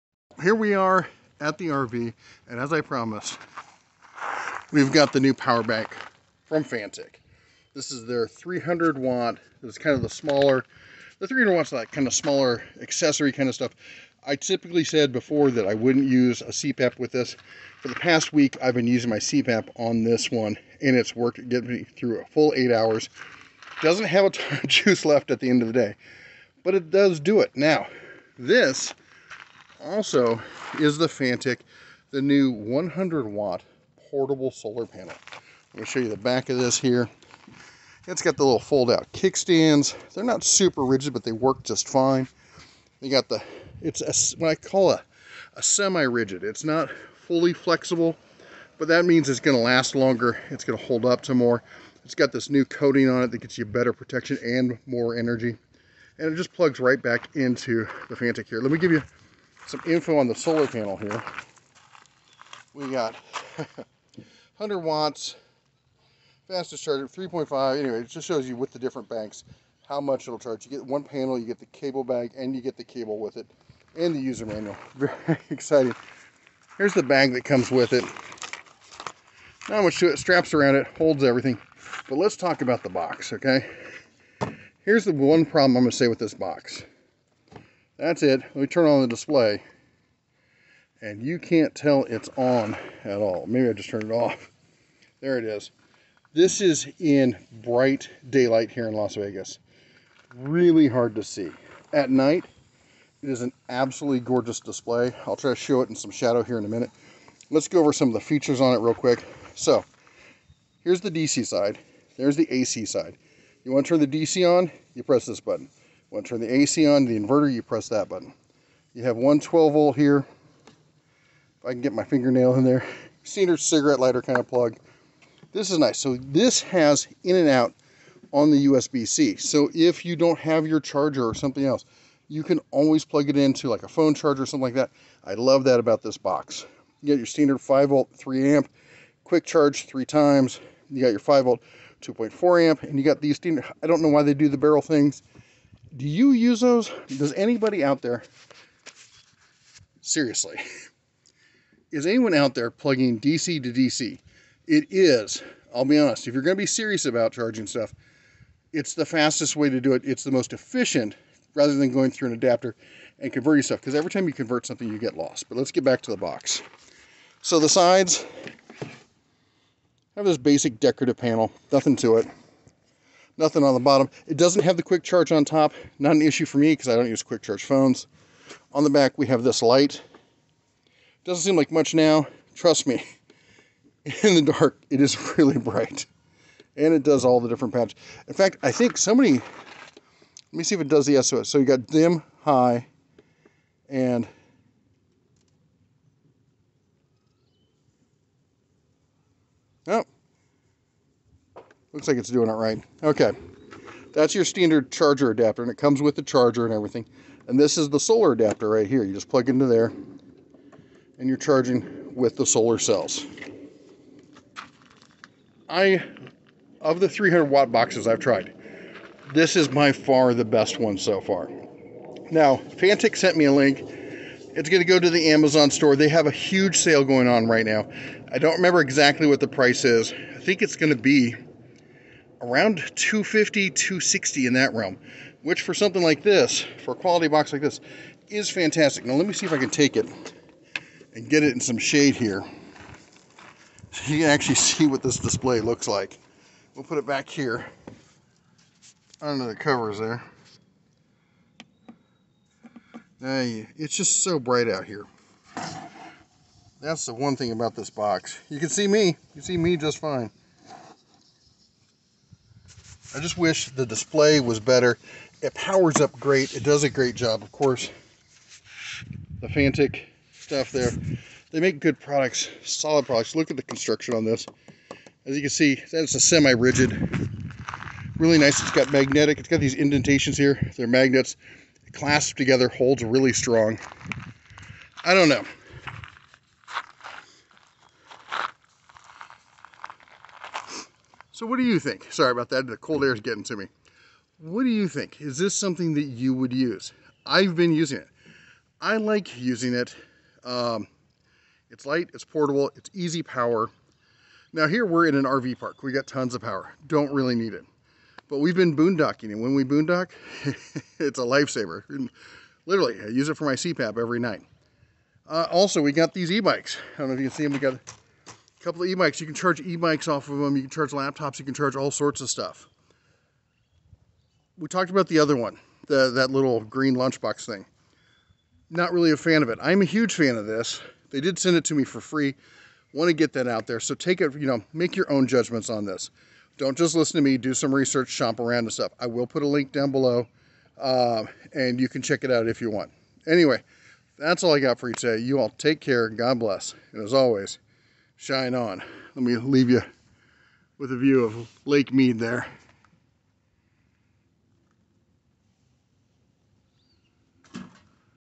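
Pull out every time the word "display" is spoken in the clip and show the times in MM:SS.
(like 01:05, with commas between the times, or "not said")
01:29, 01:44, 04:05, 04:23.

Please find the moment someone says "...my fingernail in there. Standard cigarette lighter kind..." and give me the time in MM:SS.
02:01.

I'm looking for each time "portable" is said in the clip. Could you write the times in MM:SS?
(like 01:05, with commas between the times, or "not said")
00:34, 05:02.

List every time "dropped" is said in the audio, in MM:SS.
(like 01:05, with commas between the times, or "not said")
not said.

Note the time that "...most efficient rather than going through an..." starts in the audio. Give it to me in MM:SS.
02:40.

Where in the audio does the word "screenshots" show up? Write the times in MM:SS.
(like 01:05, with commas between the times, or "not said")
not said.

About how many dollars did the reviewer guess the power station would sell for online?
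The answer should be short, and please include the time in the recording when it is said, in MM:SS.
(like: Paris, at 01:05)
250, at 03:52.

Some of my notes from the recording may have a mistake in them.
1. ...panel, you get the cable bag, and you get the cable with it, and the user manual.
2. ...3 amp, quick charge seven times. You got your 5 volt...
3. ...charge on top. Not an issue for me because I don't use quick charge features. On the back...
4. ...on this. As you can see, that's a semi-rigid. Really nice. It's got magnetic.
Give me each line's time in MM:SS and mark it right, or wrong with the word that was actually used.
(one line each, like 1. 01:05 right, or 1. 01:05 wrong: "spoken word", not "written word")
1. 01:11 right
2. 02:18 wrong: "three", not "seven"
3. 02:55 wrong: "phones", not "features"
4. 04:34 right.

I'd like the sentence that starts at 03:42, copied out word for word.
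Now, Fanttik sent me a link.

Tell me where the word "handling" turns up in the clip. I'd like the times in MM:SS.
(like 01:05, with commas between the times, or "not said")
not said.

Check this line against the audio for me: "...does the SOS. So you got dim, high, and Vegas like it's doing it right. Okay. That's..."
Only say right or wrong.
wrong.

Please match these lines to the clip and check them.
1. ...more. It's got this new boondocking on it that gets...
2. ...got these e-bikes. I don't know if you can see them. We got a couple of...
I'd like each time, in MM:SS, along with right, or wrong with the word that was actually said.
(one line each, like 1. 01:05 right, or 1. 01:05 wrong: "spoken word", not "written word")
1. 00:51 wrong: "coating", not "boondocking"
2. 05:15 right.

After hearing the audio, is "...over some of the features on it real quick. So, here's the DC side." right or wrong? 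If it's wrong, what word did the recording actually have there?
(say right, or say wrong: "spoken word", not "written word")
right.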